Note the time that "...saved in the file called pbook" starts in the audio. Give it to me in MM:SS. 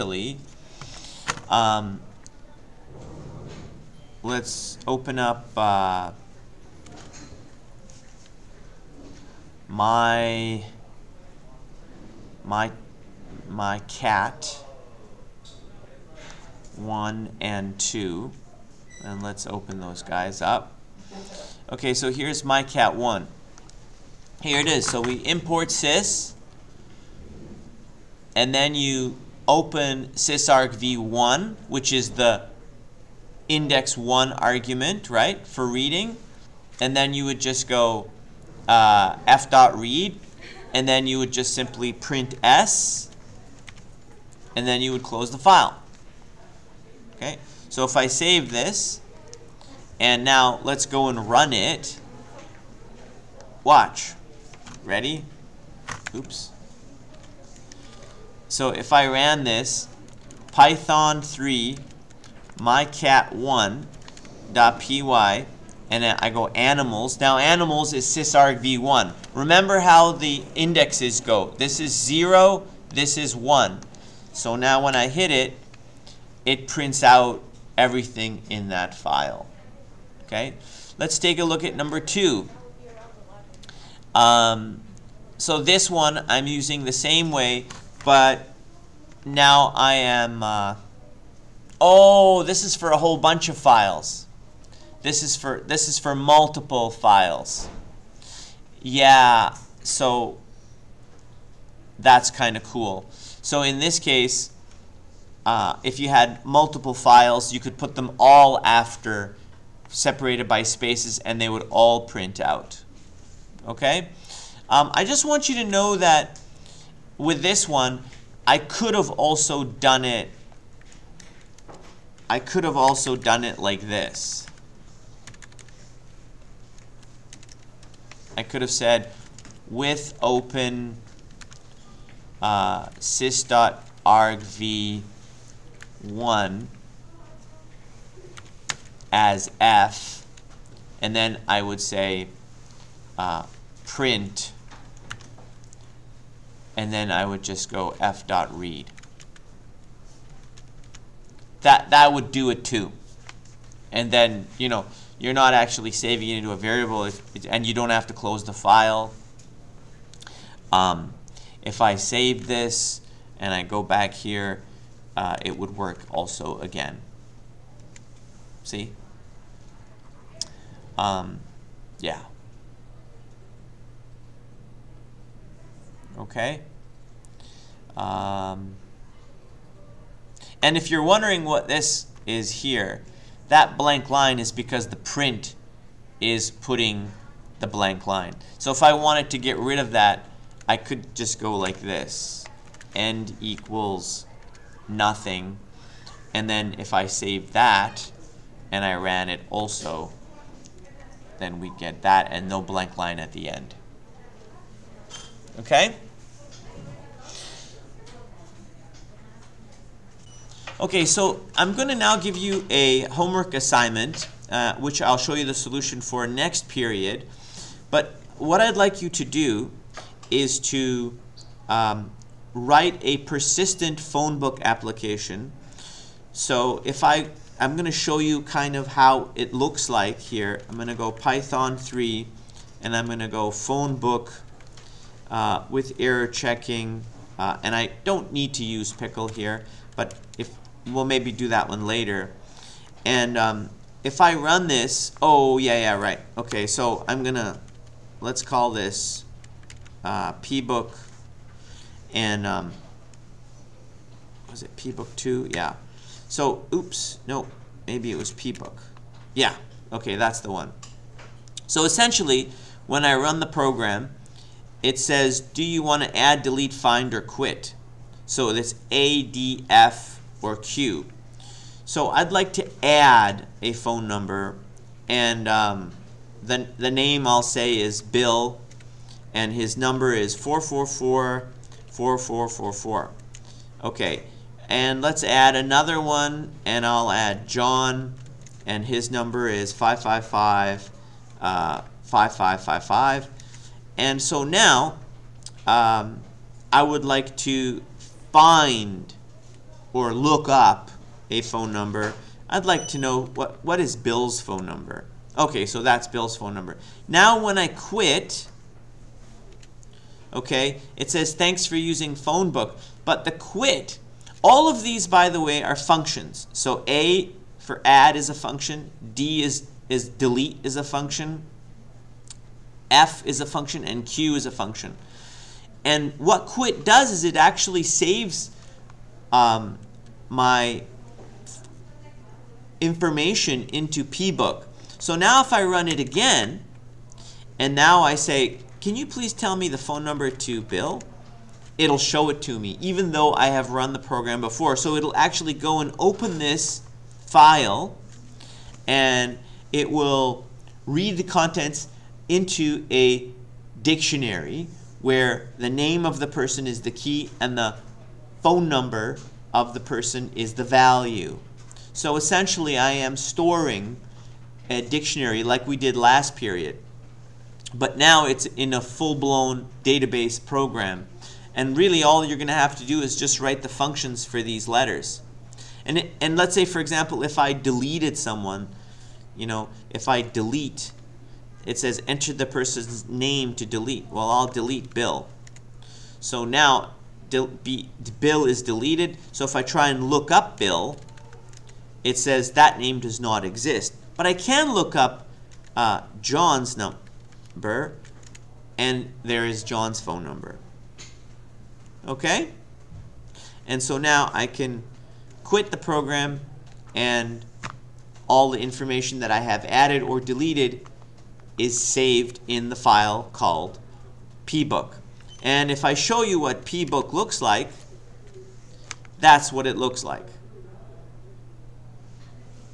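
06:51.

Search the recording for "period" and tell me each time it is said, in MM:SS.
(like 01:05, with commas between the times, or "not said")
03:36, 06:06.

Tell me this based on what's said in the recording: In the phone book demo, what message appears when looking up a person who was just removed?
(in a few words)
that name does not exist.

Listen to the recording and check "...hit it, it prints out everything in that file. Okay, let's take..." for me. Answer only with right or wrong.
right.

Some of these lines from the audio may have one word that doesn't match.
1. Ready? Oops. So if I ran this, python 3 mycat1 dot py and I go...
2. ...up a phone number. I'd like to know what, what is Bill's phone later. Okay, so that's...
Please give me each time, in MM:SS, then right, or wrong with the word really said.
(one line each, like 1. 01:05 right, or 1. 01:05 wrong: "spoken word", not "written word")
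1. 00:54 right
2. 05:00 wrong: "number", not "later".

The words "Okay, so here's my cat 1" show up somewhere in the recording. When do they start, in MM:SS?
00:21.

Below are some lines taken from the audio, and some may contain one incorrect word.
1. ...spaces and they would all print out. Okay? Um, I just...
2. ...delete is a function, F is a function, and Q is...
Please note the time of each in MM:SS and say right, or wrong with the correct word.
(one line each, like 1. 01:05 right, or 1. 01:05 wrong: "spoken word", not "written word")
1. 01:50 right
2. 05:20 right.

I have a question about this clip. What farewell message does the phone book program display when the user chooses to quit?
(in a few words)
thanks for using phone book.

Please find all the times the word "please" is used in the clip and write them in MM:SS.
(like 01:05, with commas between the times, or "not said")
05:39.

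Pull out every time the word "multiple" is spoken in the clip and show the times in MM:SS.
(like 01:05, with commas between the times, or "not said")
01:36, 01:46.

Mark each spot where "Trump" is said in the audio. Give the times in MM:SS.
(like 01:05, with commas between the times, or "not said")
not said.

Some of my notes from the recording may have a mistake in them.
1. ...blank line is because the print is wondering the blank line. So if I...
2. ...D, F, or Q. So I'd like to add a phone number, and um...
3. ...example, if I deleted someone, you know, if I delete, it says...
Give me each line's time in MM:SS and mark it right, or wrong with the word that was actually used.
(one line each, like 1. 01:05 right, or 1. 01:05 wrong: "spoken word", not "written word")
1. 03:03 wrong: "putting", not "wondering"
2. 04:29 right
3. 06:16 right.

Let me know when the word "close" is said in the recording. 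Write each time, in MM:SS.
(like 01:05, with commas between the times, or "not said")
00:45, 02:38.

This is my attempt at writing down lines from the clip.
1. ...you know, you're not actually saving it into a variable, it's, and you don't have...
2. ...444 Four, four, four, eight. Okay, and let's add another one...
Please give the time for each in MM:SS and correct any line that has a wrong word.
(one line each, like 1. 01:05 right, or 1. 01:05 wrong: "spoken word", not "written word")
1. 02:34 right
2. 04:40 wrong: "four", not "eight".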